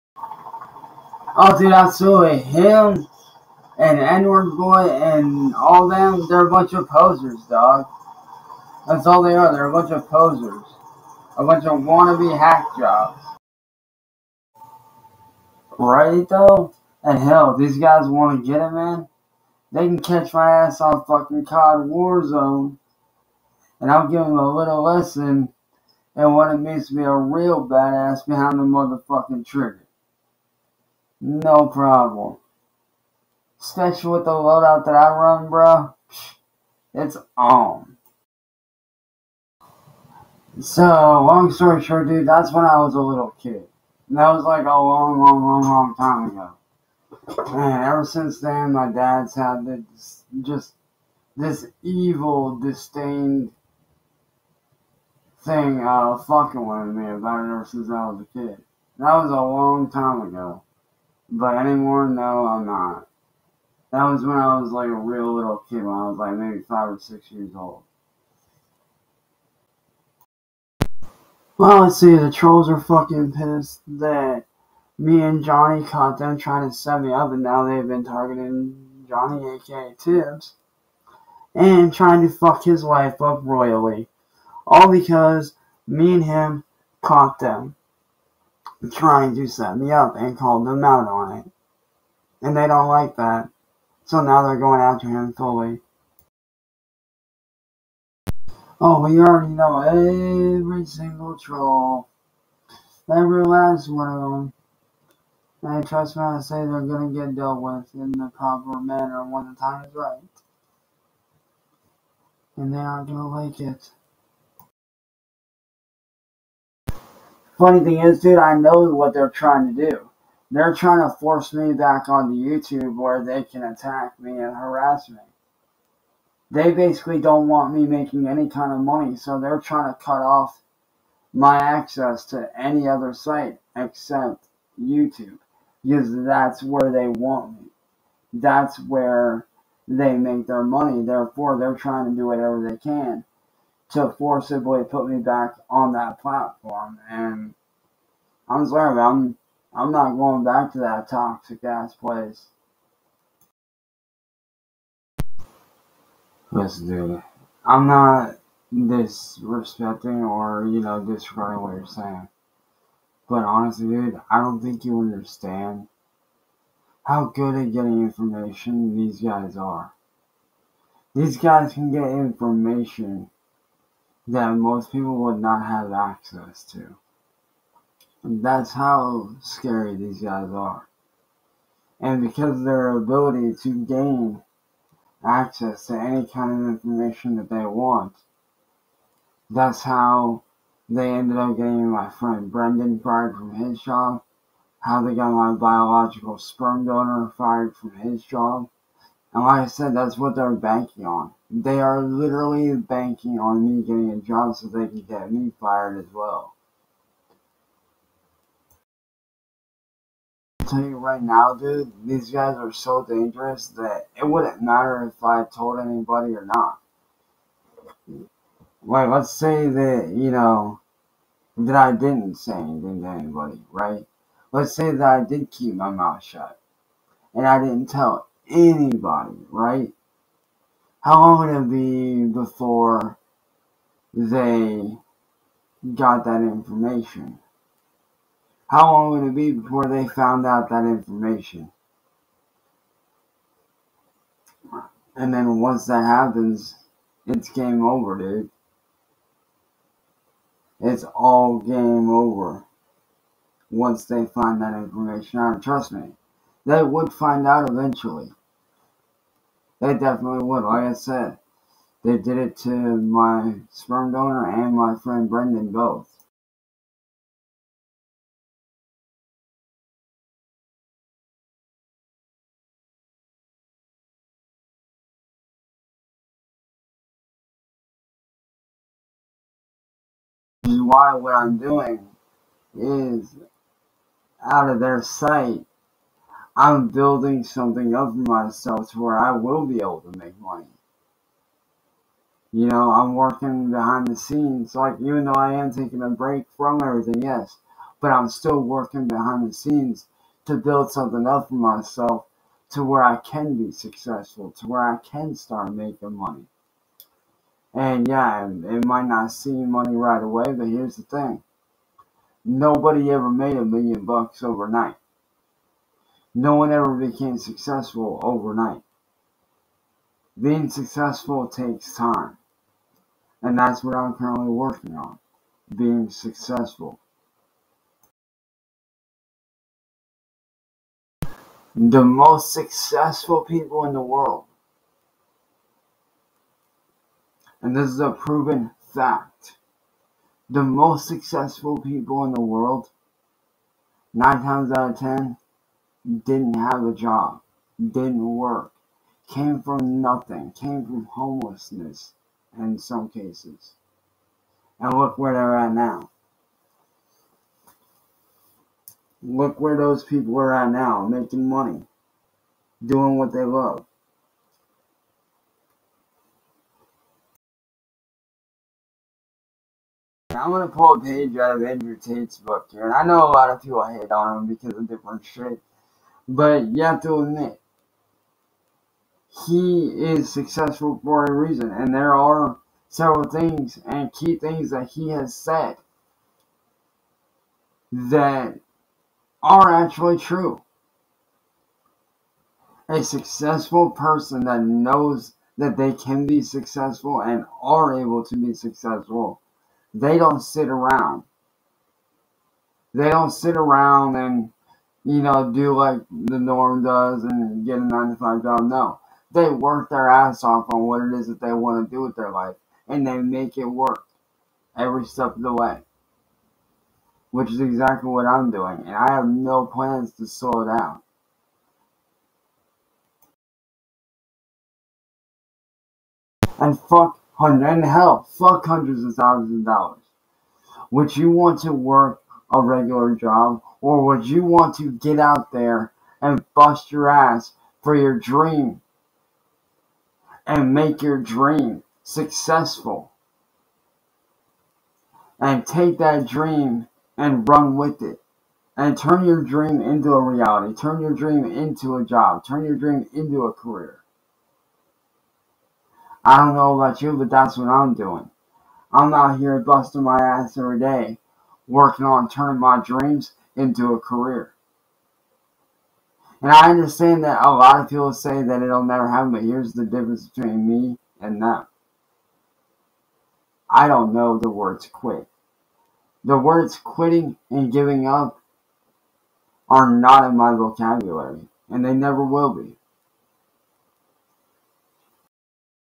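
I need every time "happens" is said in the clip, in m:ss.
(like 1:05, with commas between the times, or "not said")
4:06, 7:49.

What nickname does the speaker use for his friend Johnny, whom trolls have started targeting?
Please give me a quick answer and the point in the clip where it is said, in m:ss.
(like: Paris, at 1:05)
Tibbs, at 1:19.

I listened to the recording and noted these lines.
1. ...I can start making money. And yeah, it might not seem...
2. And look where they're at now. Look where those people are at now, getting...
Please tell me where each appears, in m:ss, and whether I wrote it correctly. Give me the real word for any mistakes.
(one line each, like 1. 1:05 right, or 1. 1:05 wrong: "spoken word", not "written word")
1. 5:04 right
2. 5:54 wrong: "making", not "getting".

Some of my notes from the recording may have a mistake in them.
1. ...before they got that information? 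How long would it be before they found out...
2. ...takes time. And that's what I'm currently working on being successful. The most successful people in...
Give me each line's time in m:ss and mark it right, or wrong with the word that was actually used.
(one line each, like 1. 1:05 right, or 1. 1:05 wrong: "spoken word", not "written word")
1. 3:52 right
2. 5:21 right.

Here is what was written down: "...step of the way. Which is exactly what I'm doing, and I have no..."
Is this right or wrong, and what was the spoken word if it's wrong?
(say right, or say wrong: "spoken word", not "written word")
right.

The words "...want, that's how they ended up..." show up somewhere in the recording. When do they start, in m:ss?
3:07.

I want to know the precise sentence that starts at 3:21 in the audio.
They are literally banking on me getting a job so they can get me fired as well.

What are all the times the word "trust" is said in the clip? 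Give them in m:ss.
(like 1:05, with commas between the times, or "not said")
1:45, 4:15.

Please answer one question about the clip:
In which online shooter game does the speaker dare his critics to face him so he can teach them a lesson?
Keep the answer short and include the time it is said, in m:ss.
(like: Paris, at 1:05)
COD Warzone, at 0:21.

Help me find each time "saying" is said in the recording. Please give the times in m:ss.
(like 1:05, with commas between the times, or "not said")
2:41.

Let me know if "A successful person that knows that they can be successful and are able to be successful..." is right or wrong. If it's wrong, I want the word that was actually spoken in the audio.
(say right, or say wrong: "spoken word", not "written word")
right.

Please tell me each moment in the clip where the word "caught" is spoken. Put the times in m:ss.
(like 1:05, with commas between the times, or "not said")
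1:15, 1:27.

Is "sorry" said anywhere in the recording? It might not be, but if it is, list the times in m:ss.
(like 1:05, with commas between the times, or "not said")
2:28.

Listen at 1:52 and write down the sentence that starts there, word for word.
And they aren't going to like it.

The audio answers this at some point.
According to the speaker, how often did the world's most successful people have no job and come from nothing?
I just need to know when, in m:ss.
5:44.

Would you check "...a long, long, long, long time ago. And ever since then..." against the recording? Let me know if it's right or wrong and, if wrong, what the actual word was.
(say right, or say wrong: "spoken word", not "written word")
right.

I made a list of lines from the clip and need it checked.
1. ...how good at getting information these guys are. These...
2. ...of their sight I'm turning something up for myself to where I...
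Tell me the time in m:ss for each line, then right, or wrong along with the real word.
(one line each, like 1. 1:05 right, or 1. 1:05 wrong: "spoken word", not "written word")
1. 2:47 right
2. 4:44 wrong: "building", not "turning".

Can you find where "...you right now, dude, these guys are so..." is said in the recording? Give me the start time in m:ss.
3:30.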